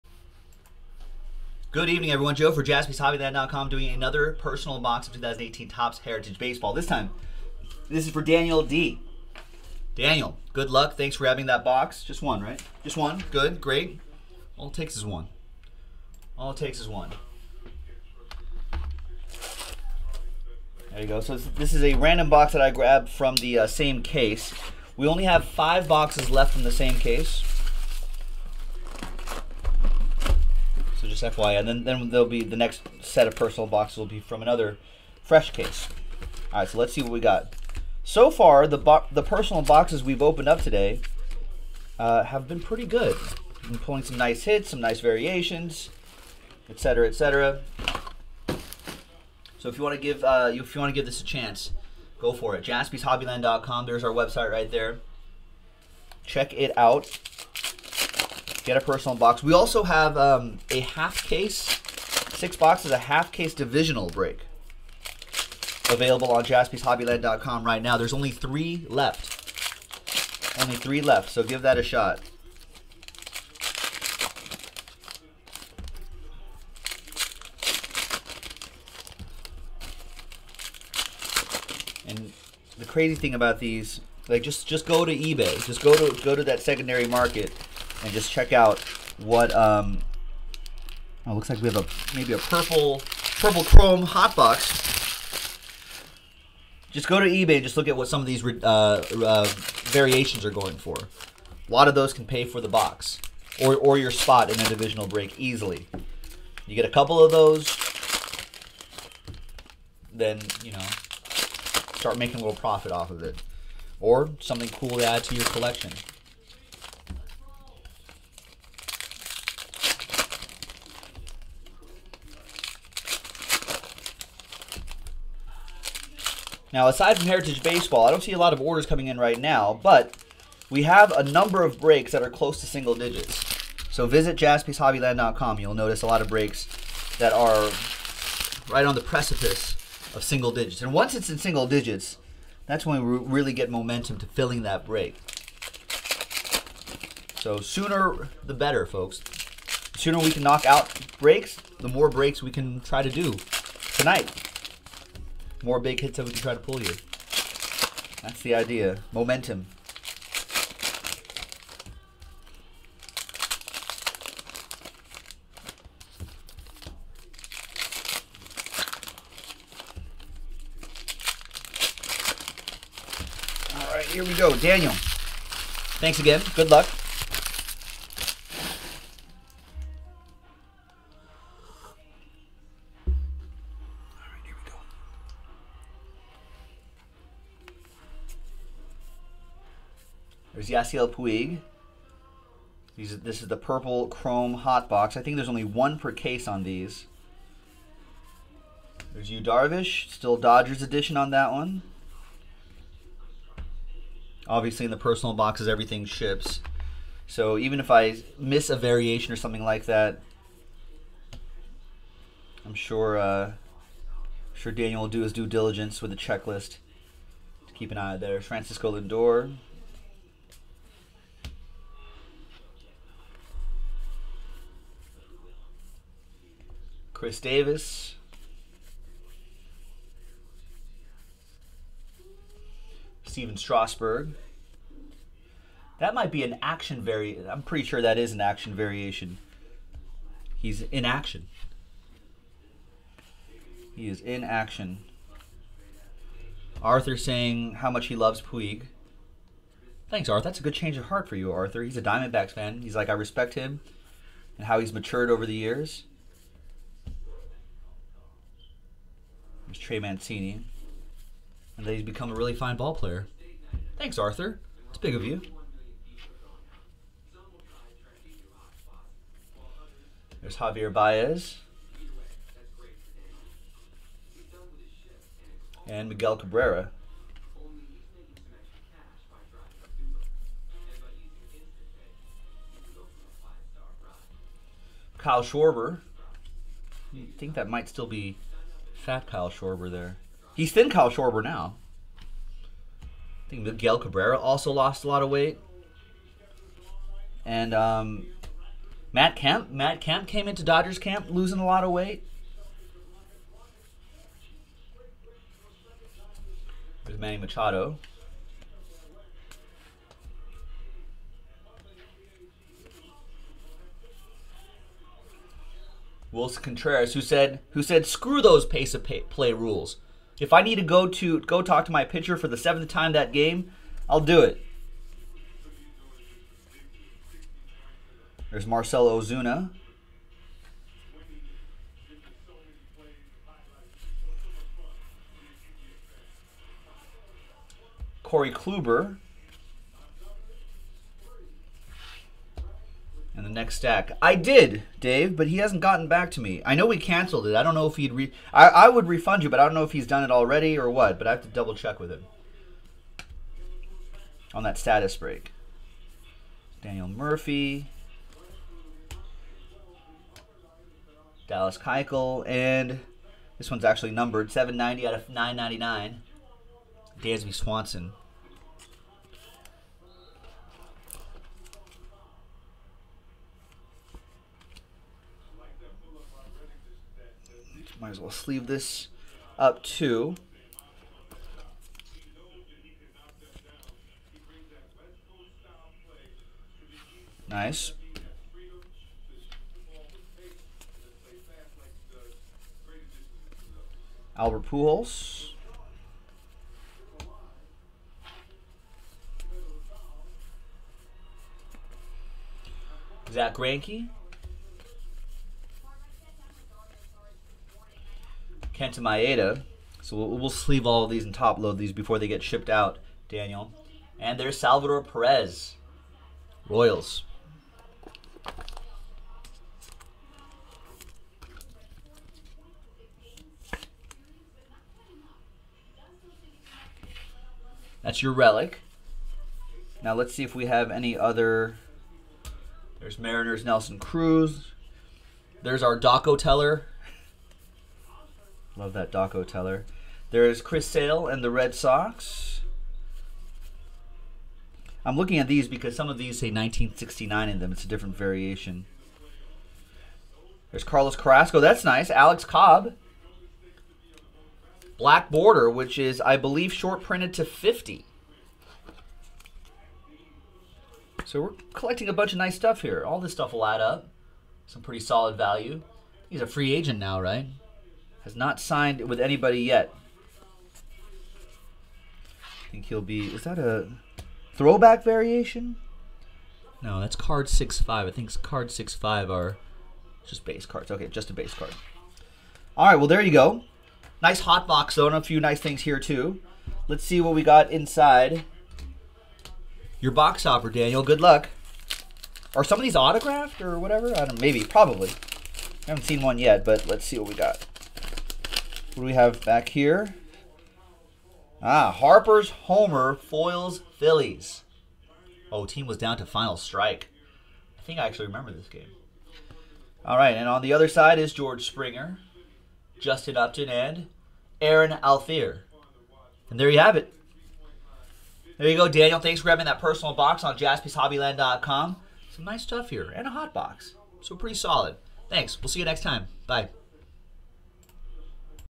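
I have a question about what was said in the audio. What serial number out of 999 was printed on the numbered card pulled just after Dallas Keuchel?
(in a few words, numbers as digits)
790.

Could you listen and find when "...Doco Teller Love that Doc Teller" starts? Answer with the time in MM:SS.
07:15.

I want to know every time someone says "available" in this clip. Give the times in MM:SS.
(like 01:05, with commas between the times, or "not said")
01:05.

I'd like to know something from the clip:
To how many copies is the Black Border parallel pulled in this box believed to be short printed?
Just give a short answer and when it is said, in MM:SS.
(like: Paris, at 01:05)
50, at 07:37.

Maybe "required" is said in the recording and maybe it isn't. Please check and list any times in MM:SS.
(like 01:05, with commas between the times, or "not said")
not said.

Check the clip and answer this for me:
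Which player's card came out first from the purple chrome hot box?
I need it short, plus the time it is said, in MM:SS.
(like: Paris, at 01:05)
Yasiel Puig, at 03:10.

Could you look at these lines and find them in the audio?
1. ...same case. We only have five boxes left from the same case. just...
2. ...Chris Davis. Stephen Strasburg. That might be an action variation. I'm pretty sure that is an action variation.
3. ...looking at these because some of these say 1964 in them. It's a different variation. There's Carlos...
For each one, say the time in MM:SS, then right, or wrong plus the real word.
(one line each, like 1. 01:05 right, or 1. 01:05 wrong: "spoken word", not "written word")
1. 00:23 right
2. 03:47 right
3. 07:25 wrong: "1969", not "1964".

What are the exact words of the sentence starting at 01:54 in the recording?
Or something cool to add to your collection.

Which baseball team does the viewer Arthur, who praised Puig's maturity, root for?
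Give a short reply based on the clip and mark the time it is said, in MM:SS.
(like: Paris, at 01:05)
Diamondbacks, at 04:12.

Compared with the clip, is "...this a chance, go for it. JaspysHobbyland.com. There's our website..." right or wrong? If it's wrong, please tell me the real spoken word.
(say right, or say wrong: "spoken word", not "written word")
right.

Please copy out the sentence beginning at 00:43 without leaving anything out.
Been pulling some nice hits, some nice variations, etc., etc.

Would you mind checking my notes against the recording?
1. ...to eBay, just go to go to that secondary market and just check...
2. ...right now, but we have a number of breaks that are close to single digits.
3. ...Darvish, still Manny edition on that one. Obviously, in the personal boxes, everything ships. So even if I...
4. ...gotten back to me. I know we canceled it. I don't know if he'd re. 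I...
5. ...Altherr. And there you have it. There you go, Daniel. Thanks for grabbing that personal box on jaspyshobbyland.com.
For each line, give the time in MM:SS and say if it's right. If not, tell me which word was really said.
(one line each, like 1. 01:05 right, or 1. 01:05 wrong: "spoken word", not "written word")
1. 01:25 right
2. 02:09 right
3. 03:19 wrong: "Dodgers", not "Manny"
4. 05:45 right
5. 08:35 right.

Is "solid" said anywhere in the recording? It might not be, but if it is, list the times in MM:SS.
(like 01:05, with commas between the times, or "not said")
07:45, 08:44.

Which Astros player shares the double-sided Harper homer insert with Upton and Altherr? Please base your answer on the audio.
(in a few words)
George Springer.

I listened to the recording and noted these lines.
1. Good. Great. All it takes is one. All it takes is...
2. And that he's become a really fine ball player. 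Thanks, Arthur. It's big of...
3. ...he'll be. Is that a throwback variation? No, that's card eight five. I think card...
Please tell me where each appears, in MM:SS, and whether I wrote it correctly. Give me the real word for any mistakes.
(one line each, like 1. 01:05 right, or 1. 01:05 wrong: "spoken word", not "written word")
1. 00:13 right
2. 04:21 right
3. 07:52 wrong: "six", not "eight".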